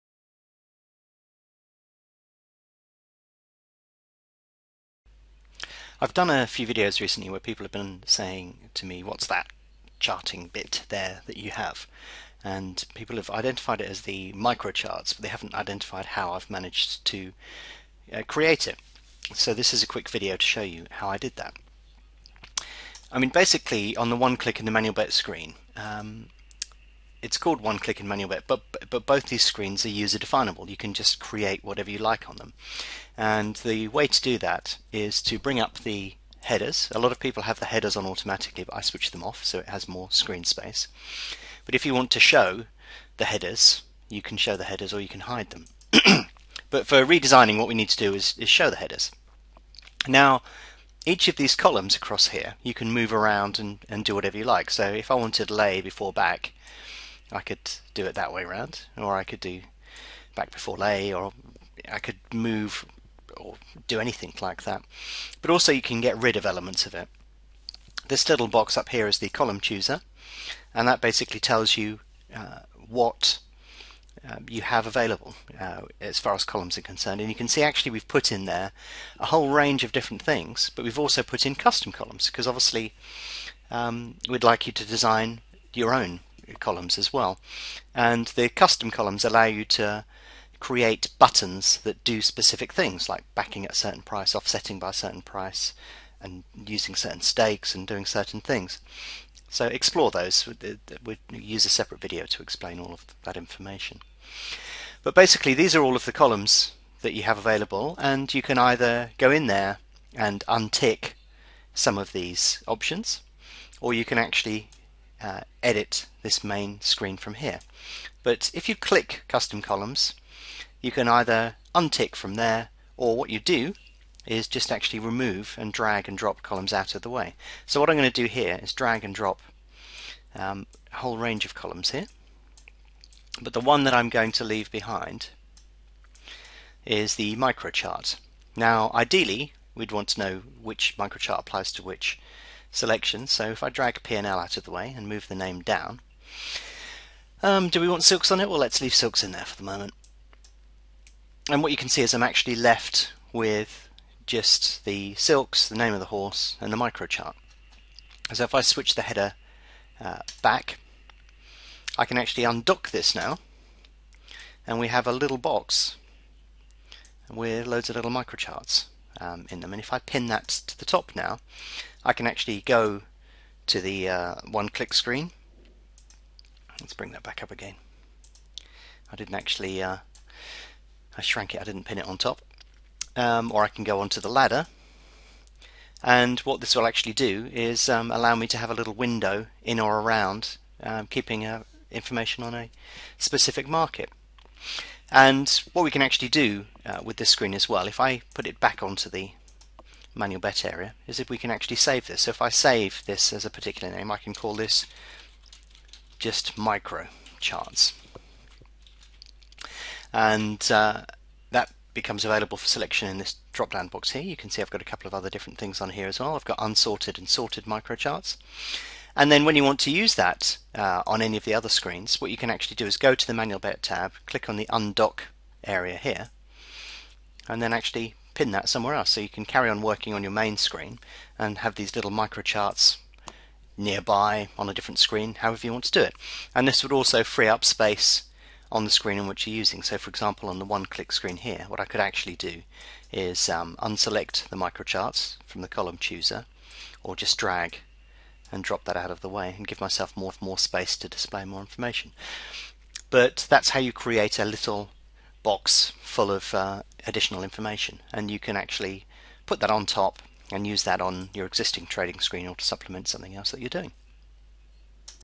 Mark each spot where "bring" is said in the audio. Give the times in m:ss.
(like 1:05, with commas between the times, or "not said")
0:35, 2:56.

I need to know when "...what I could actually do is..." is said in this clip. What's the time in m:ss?
4:01.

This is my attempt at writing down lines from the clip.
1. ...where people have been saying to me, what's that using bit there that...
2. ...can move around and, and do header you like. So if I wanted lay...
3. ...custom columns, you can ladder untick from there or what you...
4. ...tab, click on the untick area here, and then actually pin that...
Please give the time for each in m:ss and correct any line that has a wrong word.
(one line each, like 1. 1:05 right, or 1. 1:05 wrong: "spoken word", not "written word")
1. 0:07 wrong: "charting", not "using"
2. 0:52 wrong: "whatever", not "header"
3. 1:59 wrong: "either", not "ladder"
4. 3:43 wrong: "undock", not "untick".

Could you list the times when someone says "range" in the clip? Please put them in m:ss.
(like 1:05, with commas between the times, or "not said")
1:19, 2:11.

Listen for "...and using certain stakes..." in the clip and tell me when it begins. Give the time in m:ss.
1:36.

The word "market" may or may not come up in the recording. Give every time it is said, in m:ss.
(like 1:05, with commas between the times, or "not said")
3:13.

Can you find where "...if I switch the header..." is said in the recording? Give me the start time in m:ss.
2:38.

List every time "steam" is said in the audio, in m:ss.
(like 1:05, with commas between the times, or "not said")
not said.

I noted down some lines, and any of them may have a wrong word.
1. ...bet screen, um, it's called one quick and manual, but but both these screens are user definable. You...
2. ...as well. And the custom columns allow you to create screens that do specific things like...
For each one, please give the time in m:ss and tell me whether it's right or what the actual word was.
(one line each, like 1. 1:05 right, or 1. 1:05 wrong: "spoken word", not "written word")
1. 0:24 wrong: "click", not "quick"
2. 1:26 wrong: "buttons", not "screens".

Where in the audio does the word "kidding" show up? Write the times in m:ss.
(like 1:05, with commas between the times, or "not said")
not said.